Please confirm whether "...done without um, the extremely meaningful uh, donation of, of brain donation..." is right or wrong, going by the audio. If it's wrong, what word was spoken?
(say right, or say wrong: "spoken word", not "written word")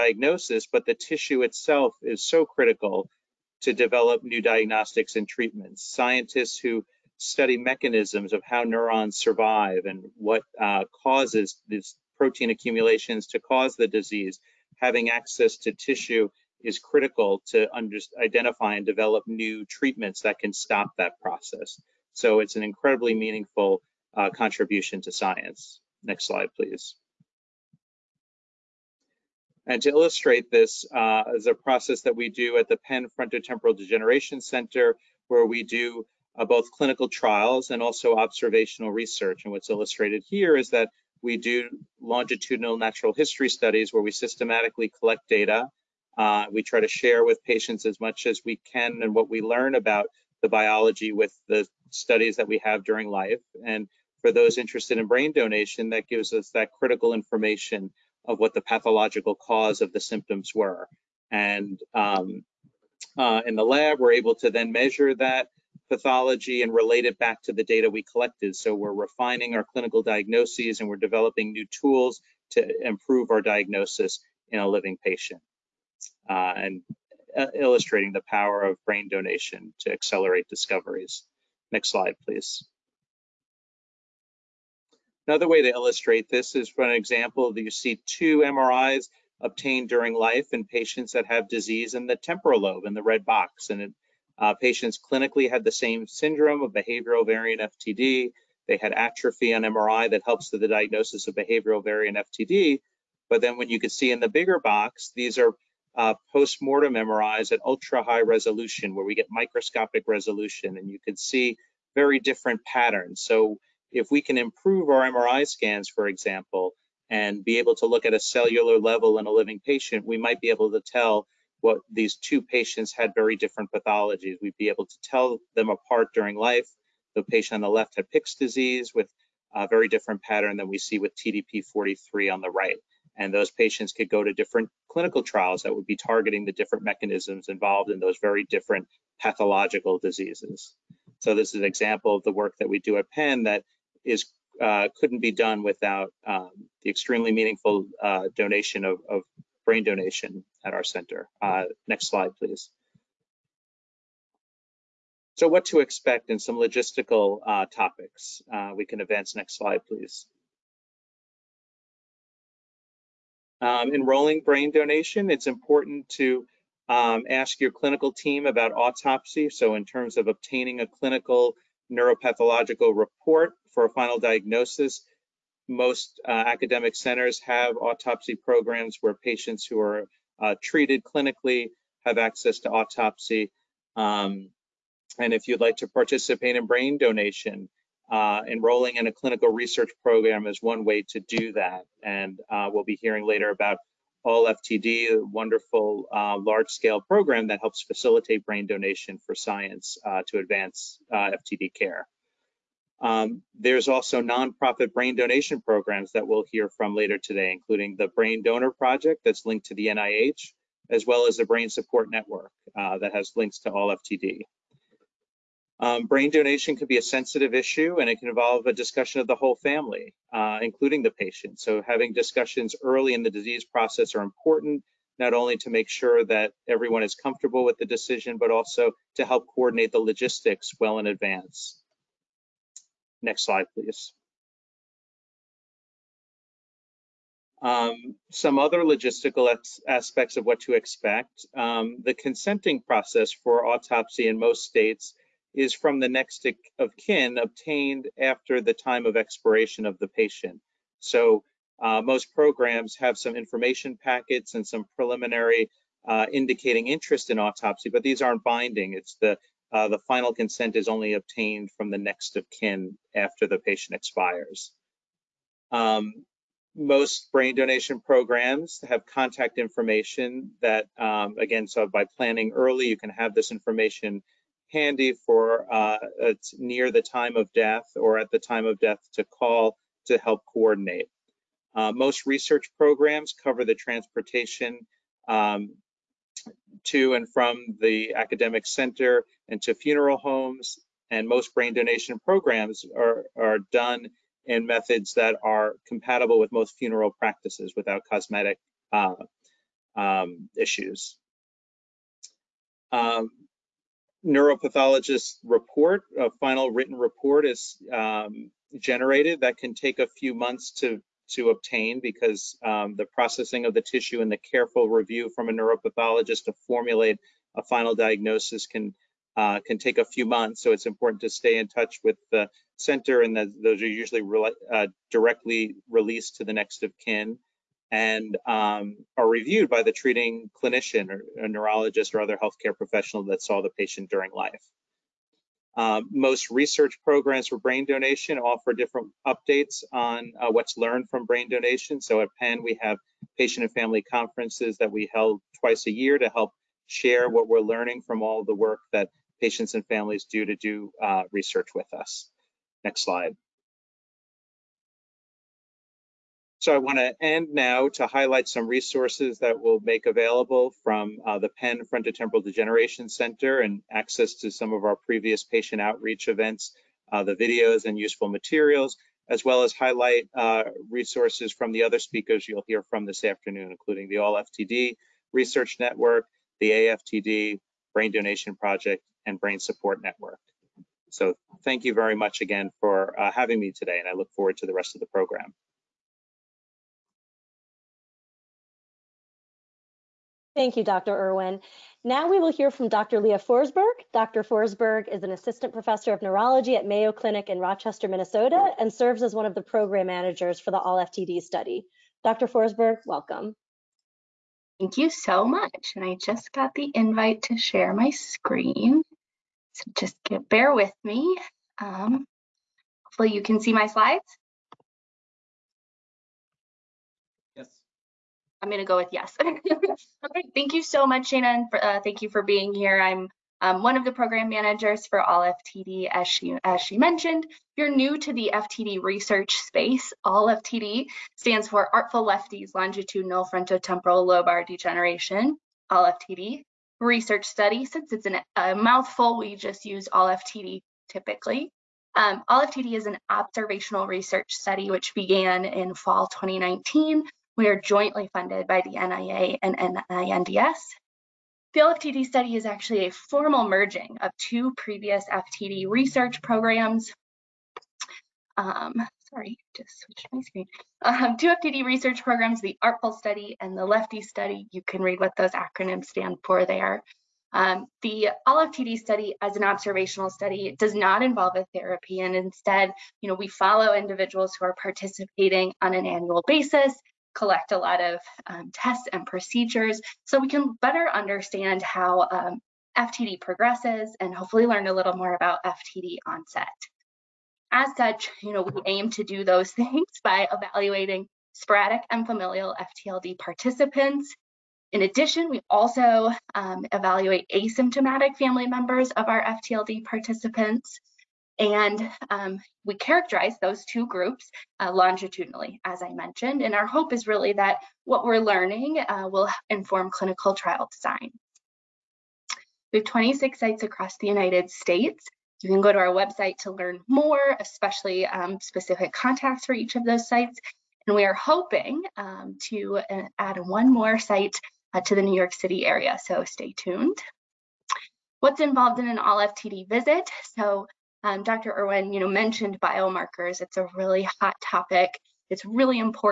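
right.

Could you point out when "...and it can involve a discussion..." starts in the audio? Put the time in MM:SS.
03:38.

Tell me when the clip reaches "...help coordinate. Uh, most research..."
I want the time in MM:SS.
04:40.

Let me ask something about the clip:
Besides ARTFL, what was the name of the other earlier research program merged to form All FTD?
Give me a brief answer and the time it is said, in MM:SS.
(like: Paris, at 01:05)
Lefty Study, at 07:43.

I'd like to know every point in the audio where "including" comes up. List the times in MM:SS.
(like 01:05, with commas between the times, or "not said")
03:27, 03:40, 06:13.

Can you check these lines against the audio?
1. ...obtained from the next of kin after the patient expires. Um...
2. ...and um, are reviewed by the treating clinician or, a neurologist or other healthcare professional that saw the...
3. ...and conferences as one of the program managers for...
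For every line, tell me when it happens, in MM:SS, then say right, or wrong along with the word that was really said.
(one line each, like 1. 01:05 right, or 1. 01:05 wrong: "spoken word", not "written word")
1. 04:21 right
2. 05:27 right
3. 06:38 wrong: "serves", not "conferences".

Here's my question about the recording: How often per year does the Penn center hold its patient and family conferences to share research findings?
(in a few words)
twice a year.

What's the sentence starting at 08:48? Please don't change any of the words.
What's involved in an all FTD visit?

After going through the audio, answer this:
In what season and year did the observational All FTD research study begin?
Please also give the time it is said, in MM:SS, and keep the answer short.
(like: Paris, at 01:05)
fall 2019, at 07:25.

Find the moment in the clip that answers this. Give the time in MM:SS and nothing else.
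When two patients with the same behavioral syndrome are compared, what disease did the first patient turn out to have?
02:08.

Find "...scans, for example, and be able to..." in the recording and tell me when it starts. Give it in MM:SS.
01:55.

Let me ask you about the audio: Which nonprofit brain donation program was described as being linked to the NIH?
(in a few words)
Brain Donor Project.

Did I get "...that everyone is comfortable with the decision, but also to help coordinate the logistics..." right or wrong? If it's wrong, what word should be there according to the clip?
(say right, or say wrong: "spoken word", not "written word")
right.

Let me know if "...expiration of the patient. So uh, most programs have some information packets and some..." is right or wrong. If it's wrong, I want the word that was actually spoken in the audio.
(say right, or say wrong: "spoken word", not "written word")
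right.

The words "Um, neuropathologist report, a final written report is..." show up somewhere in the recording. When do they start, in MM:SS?
05:02.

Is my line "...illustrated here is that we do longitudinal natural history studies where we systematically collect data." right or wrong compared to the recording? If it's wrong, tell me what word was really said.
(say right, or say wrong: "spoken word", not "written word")
right.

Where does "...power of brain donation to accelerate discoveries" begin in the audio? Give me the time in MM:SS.
01:18.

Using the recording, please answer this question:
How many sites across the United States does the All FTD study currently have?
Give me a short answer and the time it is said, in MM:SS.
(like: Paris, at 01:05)
26, at 08:33.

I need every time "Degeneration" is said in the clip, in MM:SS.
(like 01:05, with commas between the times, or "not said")
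00:33, 06:02, 07:14.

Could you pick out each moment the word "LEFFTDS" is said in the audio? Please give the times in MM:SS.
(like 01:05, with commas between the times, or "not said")
07:12.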